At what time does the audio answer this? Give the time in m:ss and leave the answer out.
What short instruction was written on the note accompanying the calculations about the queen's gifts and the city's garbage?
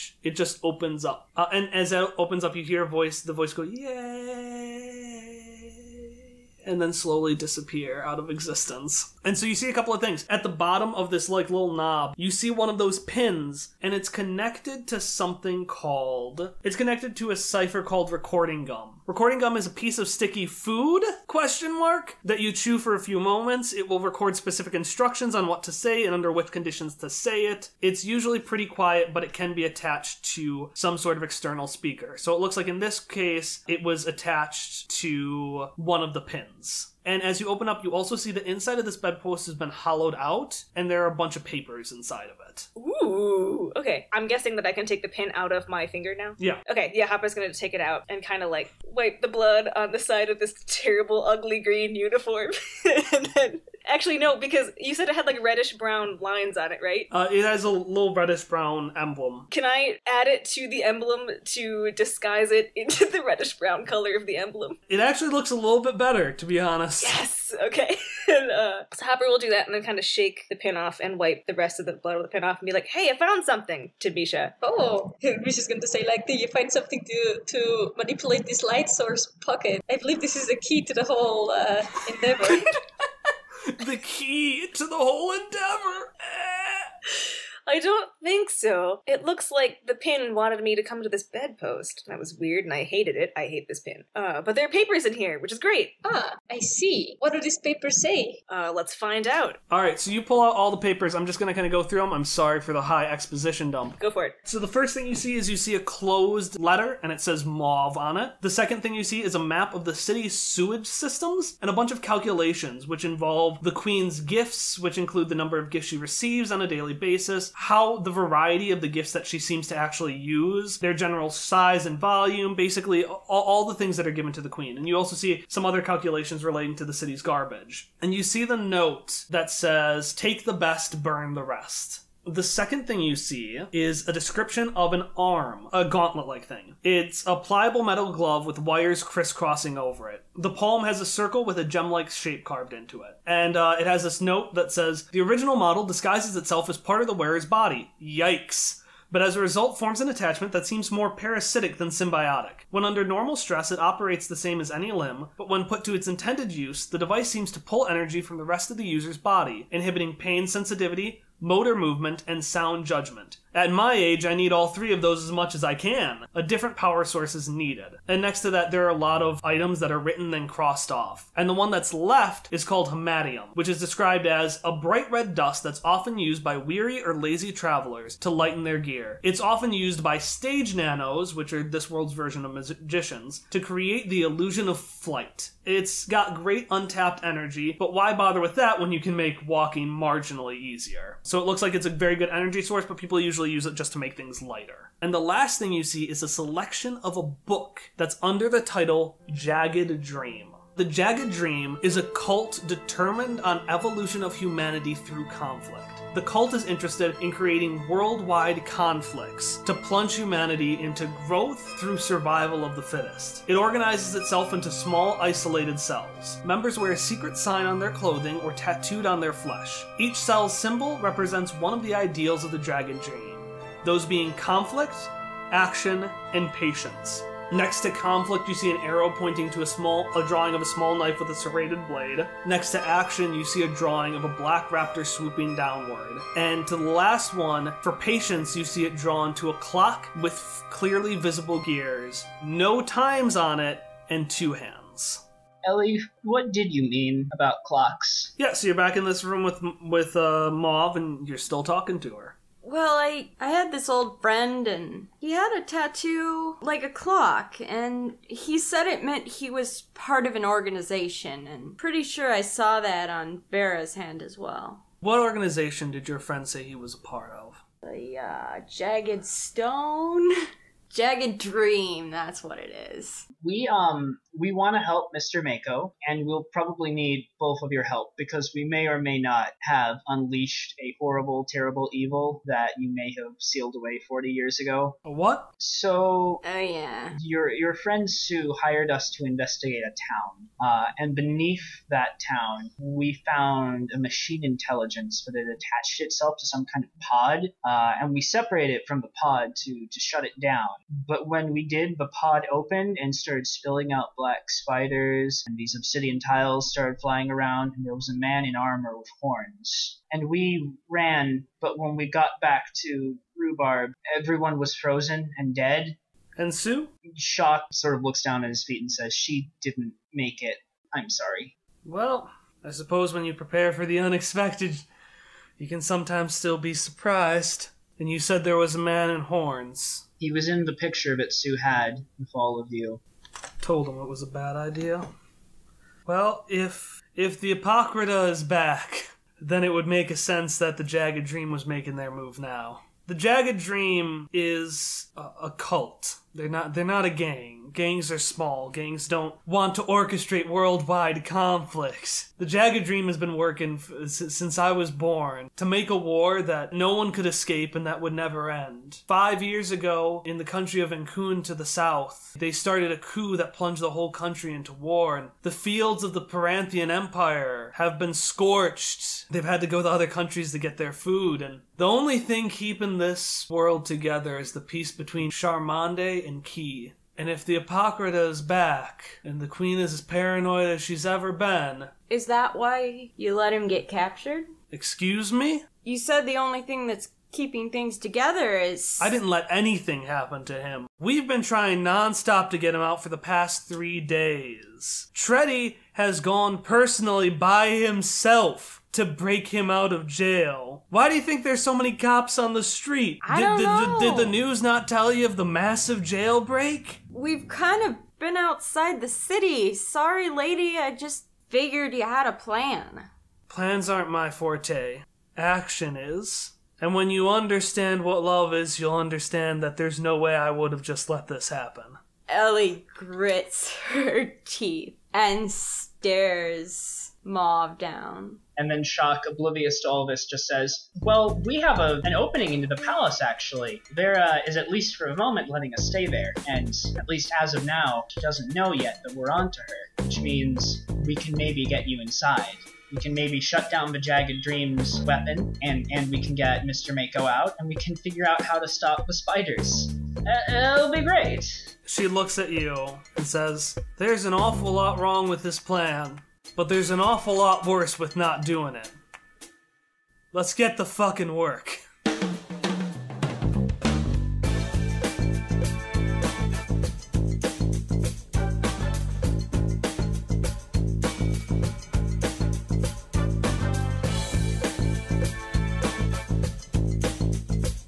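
2:10.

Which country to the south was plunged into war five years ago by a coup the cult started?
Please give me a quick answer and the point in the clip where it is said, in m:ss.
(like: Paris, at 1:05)
Ankun, at 6:00.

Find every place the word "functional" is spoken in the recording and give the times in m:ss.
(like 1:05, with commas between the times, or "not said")
not said.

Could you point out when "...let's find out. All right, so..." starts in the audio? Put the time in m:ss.
1:38.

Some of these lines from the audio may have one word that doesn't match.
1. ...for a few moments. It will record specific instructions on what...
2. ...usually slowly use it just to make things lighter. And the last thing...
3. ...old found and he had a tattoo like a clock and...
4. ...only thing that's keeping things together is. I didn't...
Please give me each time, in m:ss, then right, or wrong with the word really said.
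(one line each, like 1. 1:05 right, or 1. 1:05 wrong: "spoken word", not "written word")
1. 0:22 right
2. 3:13 wrong: "usually", not "slowly"
3. 4:13 wrong: "friend", not "found"
4. 6:26 right.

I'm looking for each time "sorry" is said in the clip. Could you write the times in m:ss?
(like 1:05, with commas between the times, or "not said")
1:42, 5:21, 6:49.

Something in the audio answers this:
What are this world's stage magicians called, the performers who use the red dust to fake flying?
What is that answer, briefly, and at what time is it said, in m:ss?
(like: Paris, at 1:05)
Stage nanos, at 3:00.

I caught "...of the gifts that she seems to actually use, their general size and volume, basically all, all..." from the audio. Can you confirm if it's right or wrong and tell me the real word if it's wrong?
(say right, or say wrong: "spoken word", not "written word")
right.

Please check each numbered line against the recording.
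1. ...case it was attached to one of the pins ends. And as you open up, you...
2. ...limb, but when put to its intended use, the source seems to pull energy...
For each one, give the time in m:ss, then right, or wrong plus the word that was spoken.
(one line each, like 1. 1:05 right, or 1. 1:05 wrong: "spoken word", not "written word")
1. 0:33 right
2. 2:34 wrong: "device", not "source".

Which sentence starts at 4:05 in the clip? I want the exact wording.
Ellie, what did you mean about clocks?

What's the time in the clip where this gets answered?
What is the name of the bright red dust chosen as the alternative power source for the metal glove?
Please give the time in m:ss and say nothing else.
2:52.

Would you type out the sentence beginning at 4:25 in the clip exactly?
What organization did your friend say he was a part of?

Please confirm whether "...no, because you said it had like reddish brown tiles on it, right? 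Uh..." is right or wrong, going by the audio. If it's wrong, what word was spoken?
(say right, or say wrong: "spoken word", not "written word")
wrong: "lines", not "tiles".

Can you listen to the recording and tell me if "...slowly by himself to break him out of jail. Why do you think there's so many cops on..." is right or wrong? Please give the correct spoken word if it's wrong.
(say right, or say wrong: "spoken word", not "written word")
wrong: "personally", not "slowly".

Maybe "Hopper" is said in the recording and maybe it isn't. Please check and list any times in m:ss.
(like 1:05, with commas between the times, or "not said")
0:47, 1:09.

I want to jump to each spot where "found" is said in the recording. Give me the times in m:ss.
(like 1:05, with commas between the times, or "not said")
1:13, 4:53.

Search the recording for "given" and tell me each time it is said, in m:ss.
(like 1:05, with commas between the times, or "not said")
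2:04.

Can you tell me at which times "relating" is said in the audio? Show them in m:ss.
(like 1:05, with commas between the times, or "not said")
2:06.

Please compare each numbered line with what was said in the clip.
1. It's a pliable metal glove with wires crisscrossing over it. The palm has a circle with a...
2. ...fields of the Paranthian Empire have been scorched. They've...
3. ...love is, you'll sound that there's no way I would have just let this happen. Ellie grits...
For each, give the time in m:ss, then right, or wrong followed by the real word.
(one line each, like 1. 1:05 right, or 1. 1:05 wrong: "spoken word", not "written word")
1. 2:16 right
2. 6:05 right
3. 6:58 wrong: "understand", not "sound".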